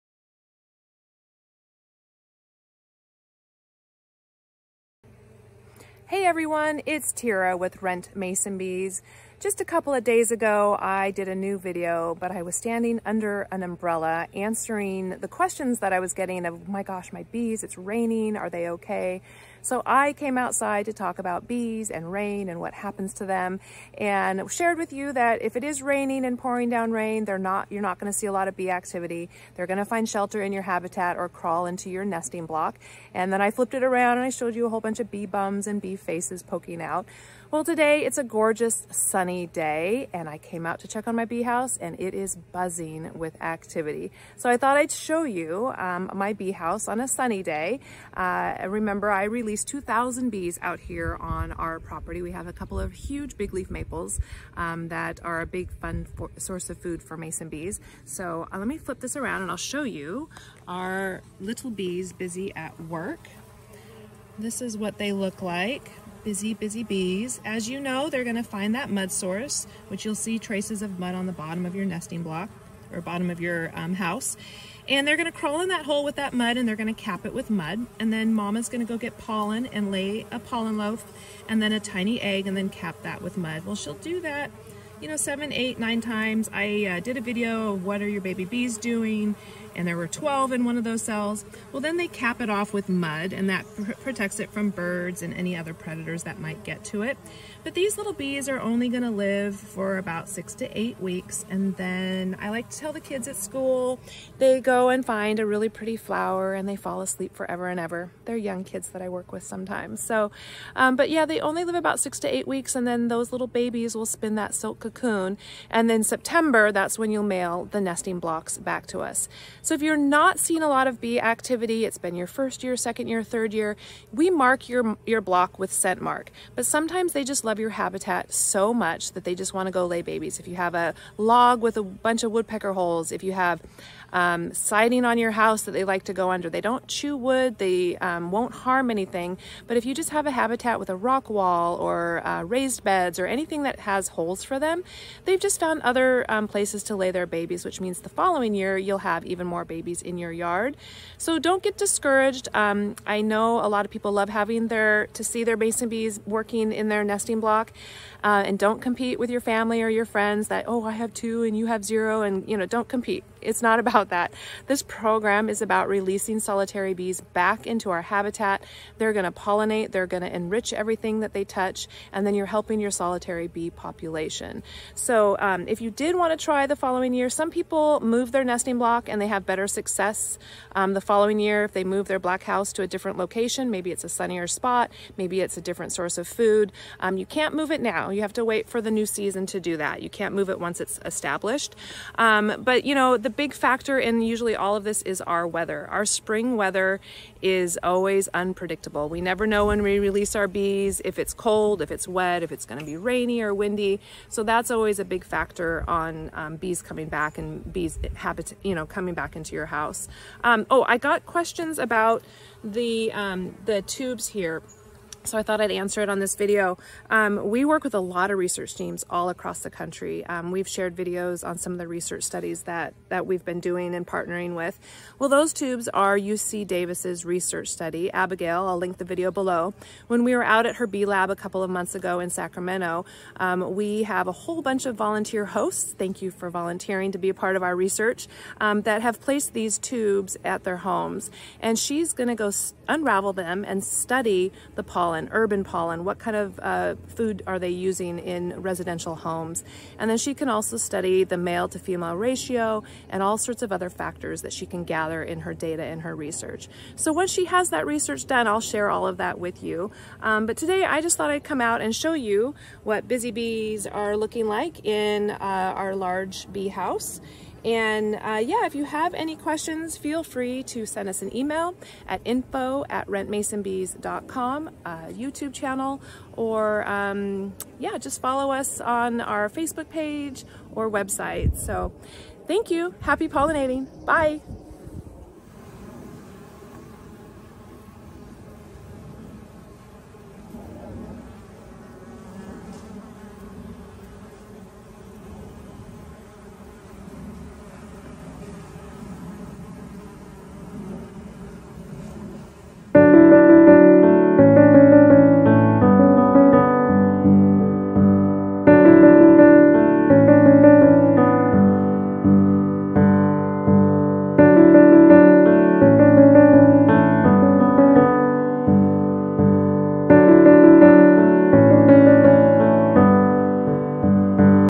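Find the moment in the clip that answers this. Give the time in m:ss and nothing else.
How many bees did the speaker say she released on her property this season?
0:49.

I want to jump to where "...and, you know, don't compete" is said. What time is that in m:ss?
2:42.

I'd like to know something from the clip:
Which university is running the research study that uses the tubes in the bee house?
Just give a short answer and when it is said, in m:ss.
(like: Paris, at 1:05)
UC Davis, at 3:46.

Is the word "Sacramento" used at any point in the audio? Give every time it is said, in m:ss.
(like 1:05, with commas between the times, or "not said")
3:52.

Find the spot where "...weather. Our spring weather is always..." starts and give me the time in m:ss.
3:15.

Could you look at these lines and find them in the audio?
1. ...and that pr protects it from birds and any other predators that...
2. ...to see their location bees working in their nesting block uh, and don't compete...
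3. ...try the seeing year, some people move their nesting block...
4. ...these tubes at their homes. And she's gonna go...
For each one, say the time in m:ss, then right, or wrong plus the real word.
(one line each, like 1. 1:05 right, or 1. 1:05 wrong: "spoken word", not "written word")
1. 1:33 right
2. 2:35 wrong: "mason", not "location"
3. 2:56 wrong: "following", not "seeing"
4. 3:59 right.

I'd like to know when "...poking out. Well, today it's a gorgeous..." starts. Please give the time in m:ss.
0:36.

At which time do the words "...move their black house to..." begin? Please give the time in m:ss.
3:01.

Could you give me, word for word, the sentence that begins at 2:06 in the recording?
But sometimes they just love your habitat so much that they just want to go lay babies.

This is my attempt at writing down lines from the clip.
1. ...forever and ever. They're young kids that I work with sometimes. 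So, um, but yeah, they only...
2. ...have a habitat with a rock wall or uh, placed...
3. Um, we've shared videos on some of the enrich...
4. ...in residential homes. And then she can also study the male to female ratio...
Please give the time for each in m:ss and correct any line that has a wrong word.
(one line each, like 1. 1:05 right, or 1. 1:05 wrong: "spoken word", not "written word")
1. 1:47 right
2. 2:20 wrong: "raised", not "placed"
3. 3:40 wrong: "research", not "enrich"
4. 4:08 right.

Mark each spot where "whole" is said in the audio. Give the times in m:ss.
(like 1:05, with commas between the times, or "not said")
0:34, 3:54.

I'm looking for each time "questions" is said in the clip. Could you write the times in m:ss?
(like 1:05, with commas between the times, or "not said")
0:15, 3:31, 4:29.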